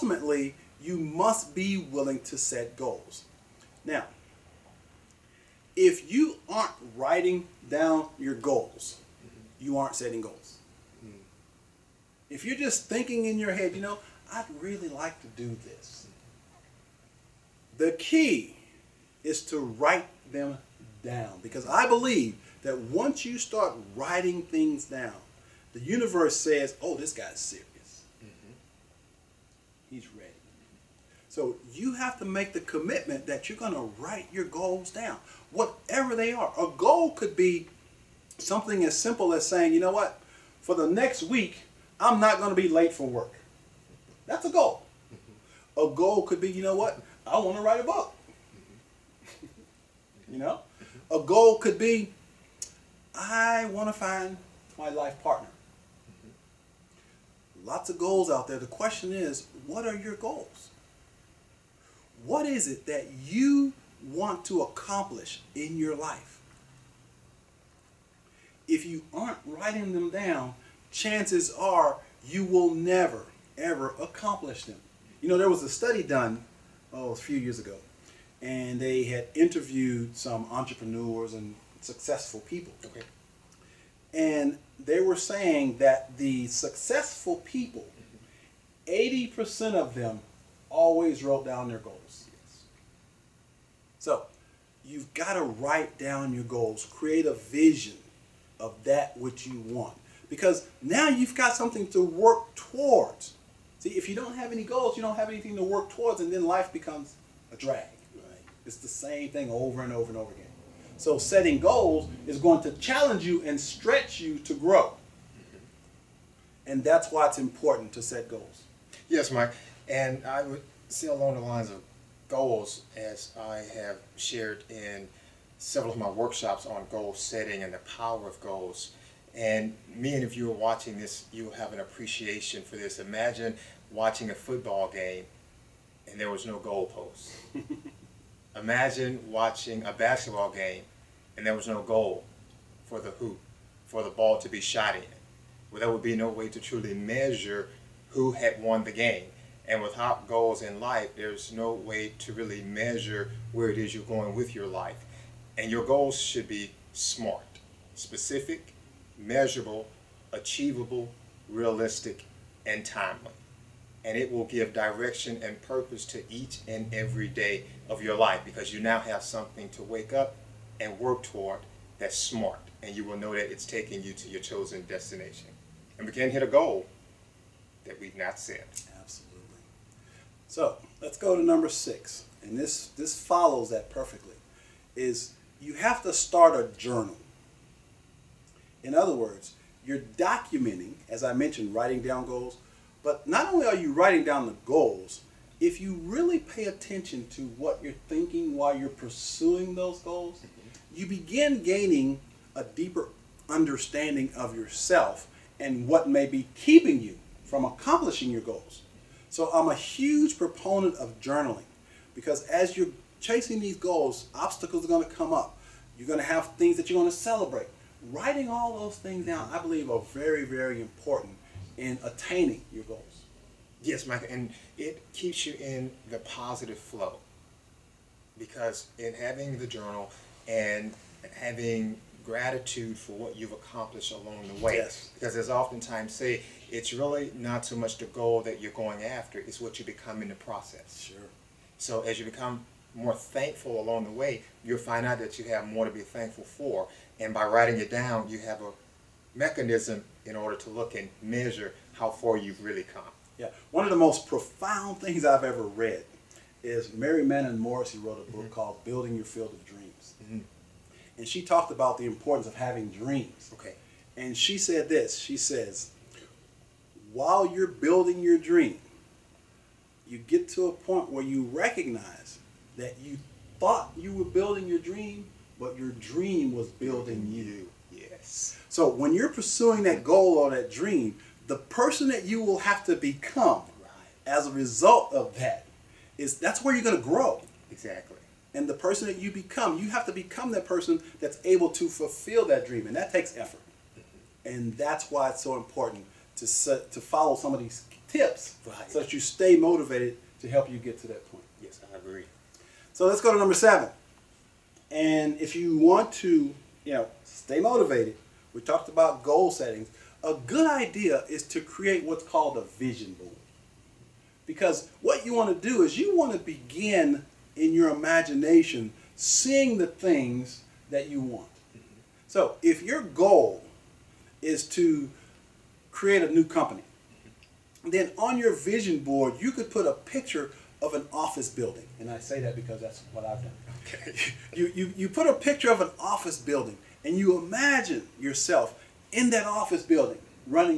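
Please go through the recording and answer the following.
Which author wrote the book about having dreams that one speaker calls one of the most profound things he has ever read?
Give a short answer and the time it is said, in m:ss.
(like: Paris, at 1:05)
Mary Manin Morrissey, at 4:16.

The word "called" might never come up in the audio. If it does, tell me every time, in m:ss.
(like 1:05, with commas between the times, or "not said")
4:18, 5:12.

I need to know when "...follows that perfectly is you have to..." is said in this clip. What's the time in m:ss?
3:03.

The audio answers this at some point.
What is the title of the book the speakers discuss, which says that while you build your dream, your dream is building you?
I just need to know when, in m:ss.
4:18.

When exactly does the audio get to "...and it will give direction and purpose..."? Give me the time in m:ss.
2:44.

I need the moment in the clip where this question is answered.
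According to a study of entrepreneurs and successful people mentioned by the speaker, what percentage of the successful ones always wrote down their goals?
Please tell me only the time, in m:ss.
1:28.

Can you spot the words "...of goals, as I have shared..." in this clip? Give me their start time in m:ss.
2:01.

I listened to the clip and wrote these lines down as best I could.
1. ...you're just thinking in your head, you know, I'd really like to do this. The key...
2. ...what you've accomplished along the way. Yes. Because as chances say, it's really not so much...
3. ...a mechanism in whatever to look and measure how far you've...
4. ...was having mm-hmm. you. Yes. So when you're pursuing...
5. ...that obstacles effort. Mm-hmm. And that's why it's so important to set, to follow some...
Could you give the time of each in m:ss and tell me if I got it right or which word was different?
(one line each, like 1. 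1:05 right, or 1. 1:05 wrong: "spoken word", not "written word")
1. 0:12 right
2. 3:53 wrong: "oftentimes", not "chances"
3. 4:08 wrong: "order", not "whatever"
4. 4:36 wrong: "building", not "having"
5. 4:52 wrong: "takes", not "obstacles".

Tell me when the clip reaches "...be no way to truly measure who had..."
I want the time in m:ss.
2:26.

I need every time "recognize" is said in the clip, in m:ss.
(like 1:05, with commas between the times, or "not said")
4:31.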